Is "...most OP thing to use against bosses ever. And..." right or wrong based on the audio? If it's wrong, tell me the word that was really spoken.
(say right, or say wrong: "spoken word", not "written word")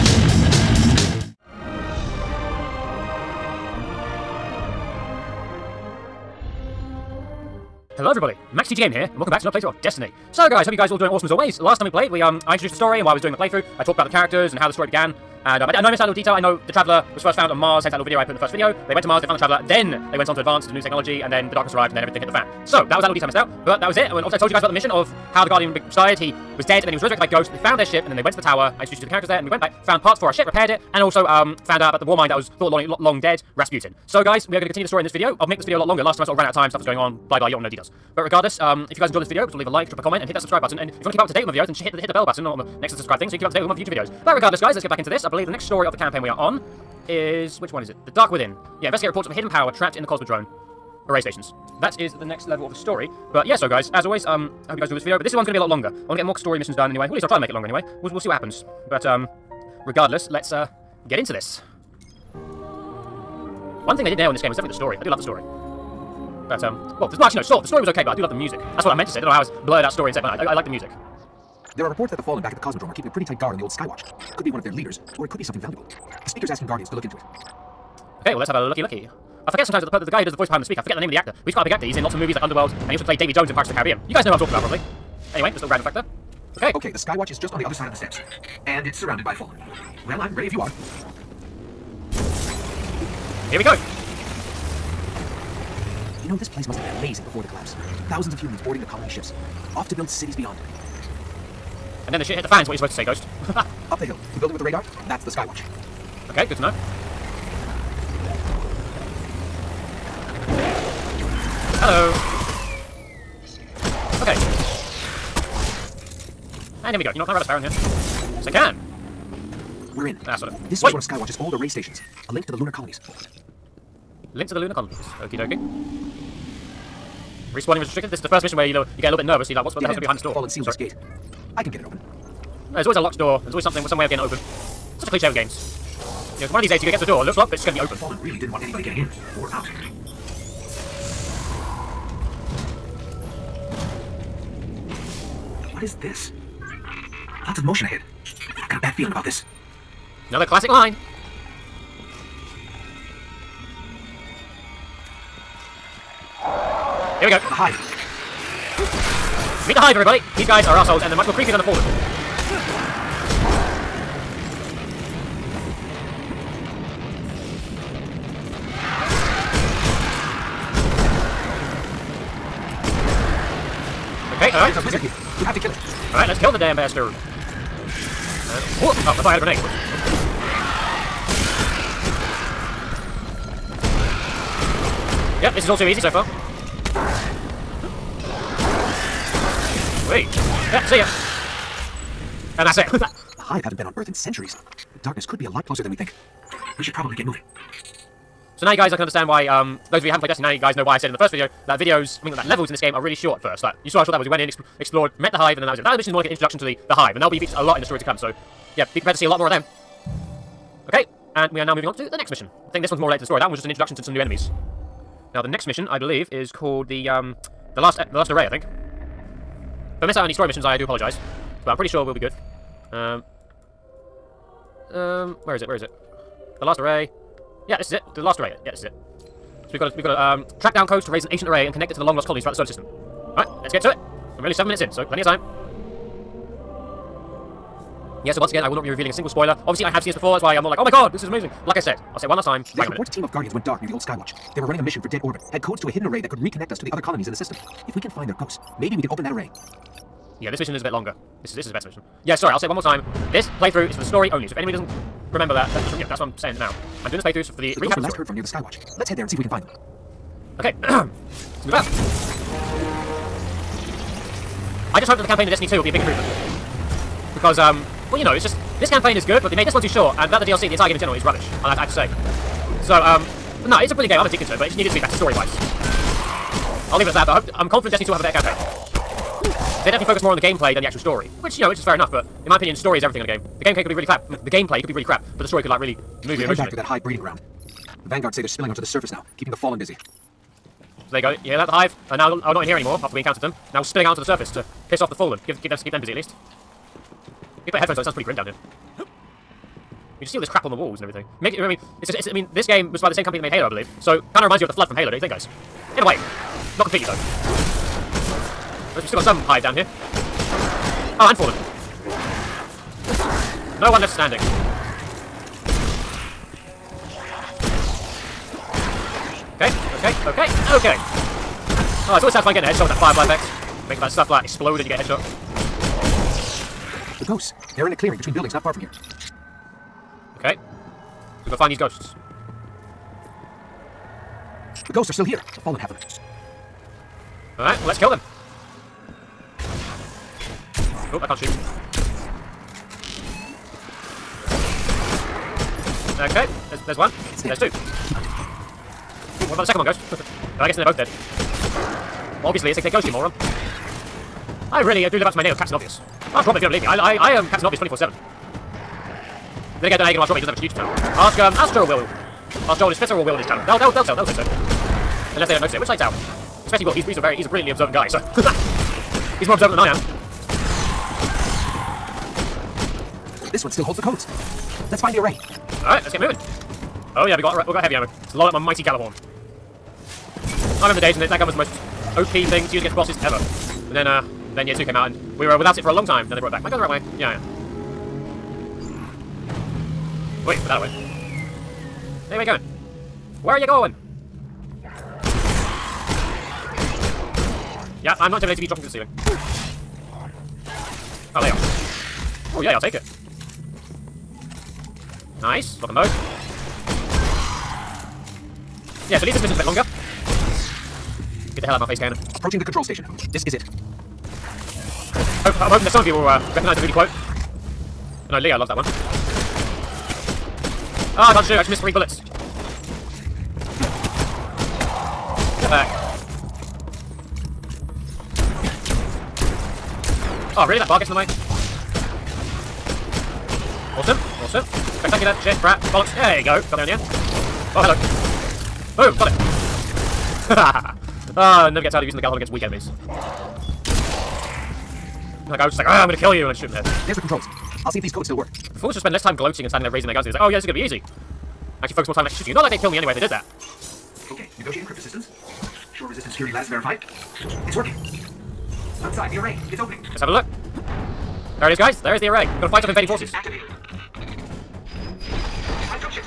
right.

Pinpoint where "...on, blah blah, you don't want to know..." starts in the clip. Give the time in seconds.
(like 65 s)
36 s.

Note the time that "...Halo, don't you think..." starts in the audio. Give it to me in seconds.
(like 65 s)
304 s.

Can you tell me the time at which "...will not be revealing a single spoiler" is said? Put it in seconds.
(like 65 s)
238 s.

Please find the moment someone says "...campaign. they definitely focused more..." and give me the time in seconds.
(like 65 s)
278 s.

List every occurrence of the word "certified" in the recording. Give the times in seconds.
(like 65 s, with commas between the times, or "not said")
not said.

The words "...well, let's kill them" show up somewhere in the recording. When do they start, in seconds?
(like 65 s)
337 s.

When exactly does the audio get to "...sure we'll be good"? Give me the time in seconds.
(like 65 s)
221 s.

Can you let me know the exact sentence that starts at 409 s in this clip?
Yeah, so at least this mission's a bit longer.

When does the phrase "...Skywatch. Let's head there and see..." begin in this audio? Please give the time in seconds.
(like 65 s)
258 s.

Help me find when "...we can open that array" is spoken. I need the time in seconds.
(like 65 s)
248 s.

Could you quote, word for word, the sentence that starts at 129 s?
So you're like, what's what the hell's going to be behind this door?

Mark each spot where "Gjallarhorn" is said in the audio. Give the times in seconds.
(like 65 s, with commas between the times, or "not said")
378 s, 442 s.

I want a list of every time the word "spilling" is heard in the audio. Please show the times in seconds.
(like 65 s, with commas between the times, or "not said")
288 s, 293 s.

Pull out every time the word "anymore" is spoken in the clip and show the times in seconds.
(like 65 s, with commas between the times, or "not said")
292 s.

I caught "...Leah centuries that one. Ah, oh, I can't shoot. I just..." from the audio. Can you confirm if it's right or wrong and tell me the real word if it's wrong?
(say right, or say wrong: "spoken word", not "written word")
wrong: "loves", not "centuries".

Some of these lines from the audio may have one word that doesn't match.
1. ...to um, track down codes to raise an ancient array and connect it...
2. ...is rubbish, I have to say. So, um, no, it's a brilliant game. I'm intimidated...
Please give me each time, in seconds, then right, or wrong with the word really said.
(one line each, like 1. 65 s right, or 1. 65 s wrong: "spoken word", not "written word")
1. 230 s right
2. 271 s wrong: "addicted", not "intimidated".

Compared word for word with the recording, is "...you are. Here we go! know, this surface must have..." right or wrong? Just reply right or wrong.
wrong.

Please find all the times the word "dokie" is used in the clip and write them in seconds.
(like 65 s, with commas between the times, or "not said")
125 s.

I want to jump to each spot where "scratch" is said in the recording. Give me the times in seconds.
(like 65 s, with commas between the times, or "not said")
not said.